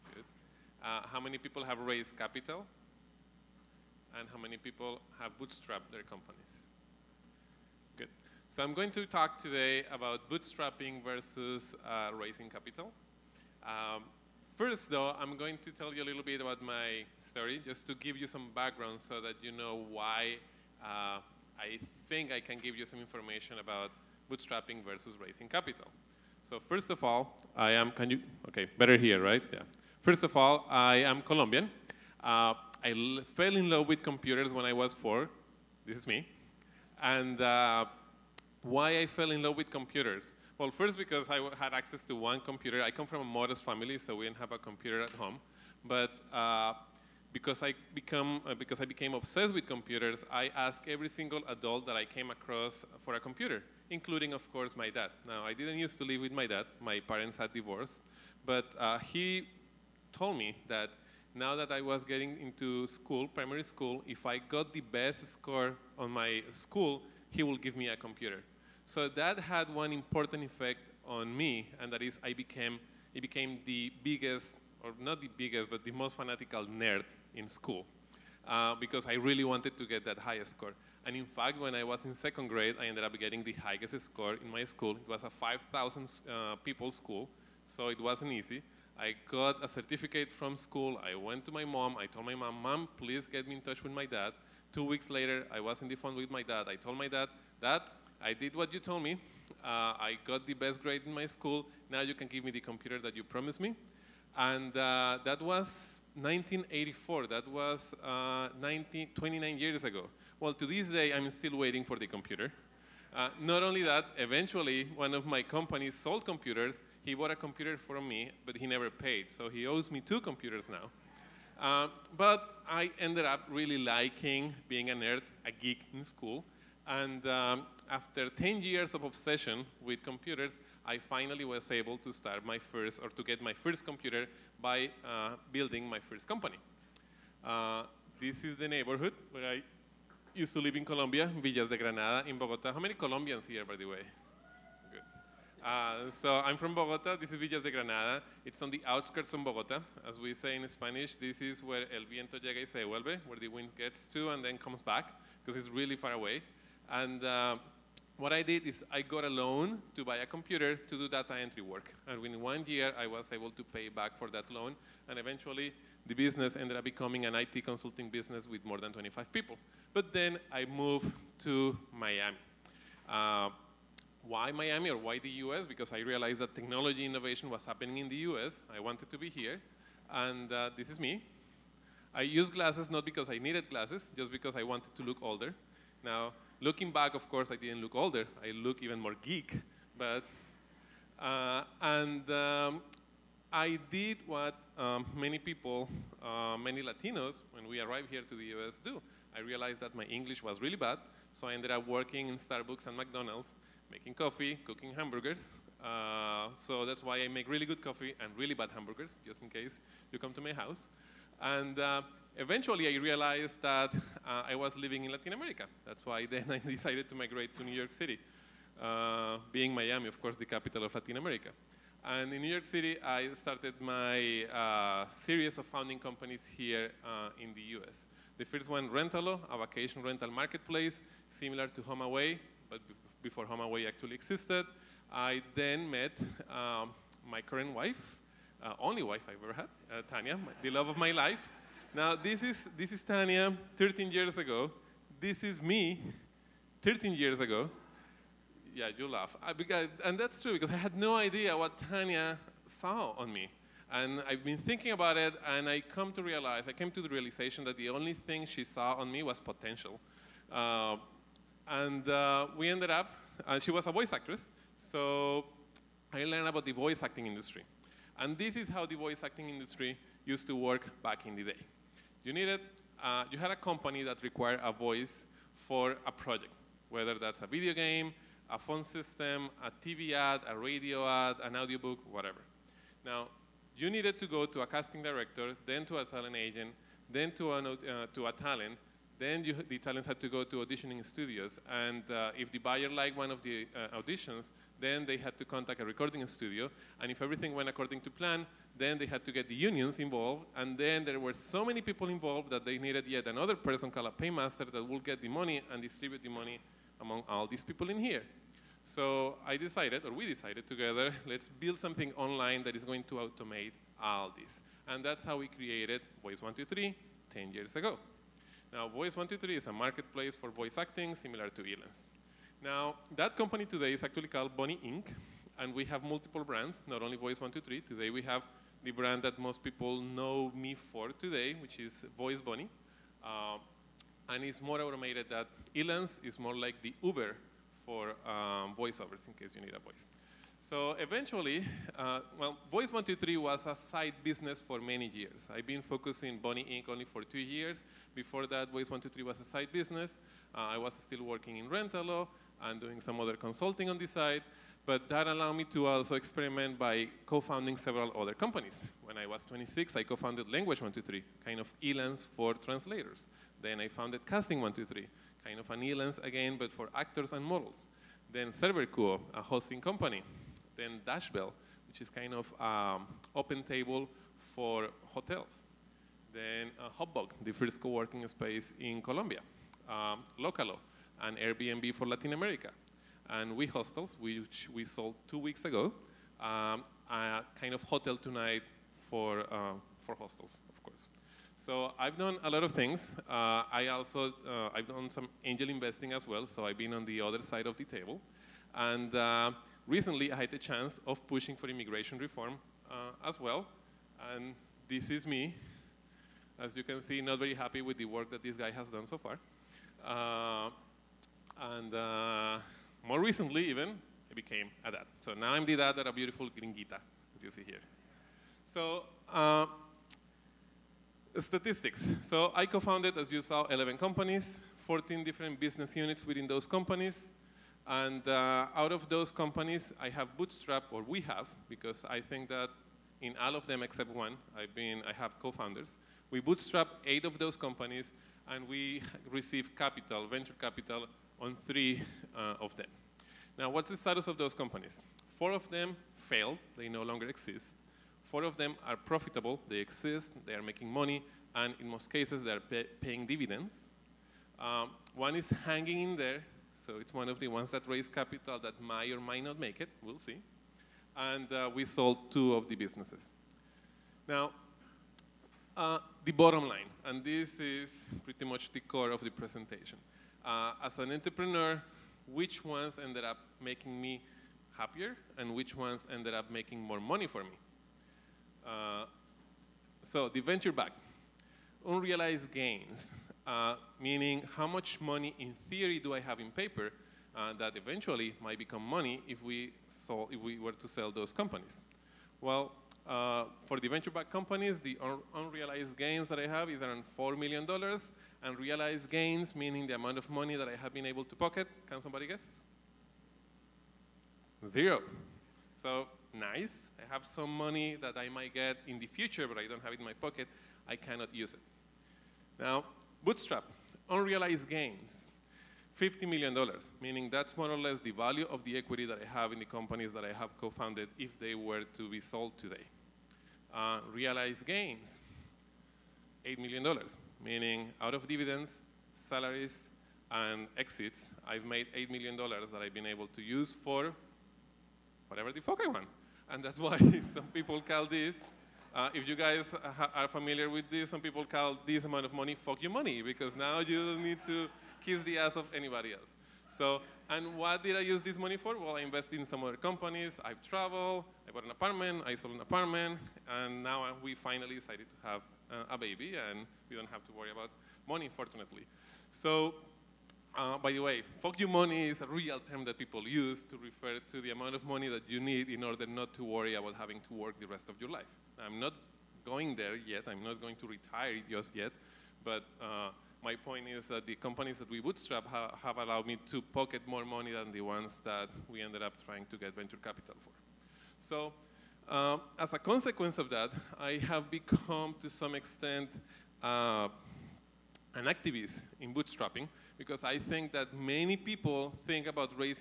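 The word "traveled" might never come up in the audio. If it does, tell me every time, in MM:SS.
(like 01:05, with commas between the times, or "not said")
09:10.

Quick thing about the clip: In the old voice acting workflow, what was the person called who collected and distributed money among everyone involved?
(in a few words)
Paymaster.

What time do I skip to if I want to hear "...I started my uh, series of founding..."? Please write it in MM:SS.
03:43.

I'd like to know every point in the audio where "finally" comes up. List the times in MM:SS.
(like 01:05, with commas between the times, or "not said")
02:10, 09:14.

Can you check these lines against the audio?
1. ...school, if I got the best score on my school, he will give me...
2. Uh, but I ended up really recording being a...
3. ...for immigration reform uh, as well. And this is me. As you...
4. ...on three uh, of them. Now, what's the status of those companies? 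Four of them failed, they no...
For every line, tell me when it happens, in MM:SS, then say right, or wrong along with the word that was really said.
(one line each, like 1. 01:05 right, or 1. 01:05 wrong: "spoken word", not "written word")
1. 01:03 right
2. 02:01 wrong: "liking", not "recording"
3. 06:41 right
4. 07:21 right.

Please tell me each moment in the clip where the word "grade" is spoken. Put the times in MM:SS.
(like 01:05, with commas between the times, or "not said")
01:22, 01:40.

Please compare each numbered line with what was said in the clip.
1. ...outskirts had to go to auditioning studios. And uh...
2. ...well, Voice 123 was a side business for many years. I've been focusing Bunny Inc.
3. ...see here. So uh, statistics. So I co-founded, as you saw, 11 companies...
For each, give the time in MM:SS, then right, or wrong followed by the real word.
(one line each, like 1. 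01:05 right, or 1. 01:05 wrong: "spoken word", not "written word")
1. 04:49 wrong: "talents", not "outskirts"
2. 05:42 right
3. 06:57 right.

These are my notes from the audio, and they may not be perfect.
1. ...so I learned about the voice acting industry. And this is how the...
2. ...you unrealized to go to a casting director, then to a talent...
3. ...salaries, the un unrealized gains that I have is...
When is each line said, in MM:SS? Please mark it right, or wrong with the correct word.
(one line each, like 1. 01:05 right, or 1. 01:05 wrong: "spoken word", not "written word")
1. 04:24 right
2. 04:43 wrong: "needed", not "unrealized"
3. 08:14 wrong: "companies", not "salaries".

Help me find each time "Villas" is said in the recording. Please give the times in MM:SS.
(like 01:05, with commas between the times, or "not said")
02:21, 02:27.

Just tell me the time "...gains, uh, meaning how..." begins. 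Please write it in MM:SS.
08:02.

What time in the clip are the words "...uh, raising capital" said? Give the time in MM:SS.
00:11.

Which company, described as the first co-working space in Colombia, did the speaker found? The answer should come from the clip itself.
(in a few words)
Hubbog.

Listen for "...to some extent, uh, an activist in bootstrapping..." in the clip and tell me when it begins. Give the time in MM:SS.
09:45.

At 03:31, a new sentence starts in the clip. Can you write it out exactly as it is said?
And uh, eventually I realized that uh, I was living in Latin America.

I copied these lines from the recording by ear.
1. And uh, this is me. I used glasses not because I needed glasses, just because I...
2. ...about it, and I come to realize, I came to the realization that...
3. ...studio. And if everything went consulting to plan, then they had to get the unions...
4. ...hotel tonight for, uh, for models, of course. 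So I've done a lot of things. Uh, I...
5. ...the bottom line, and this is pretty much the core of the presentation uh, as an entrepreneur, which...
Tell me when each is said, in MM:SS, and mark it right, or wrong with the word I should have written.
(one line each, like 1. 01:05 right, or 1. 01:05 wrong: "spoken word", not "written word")
1. 03:00 right
2. 04:14 right
3. 04:56 wrong: "according", not "consulting"
4. 06:27 wrong: "hostels", not "models"
5. 07:46 right.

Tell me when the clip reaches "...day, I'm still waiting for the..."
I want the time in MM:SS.
01:50.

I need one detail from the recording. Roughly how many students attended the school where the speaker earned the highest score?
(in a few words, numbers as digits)
5,000.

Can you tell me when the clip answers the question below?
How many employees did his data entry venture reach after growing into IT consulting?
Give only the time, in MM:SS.
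02:48.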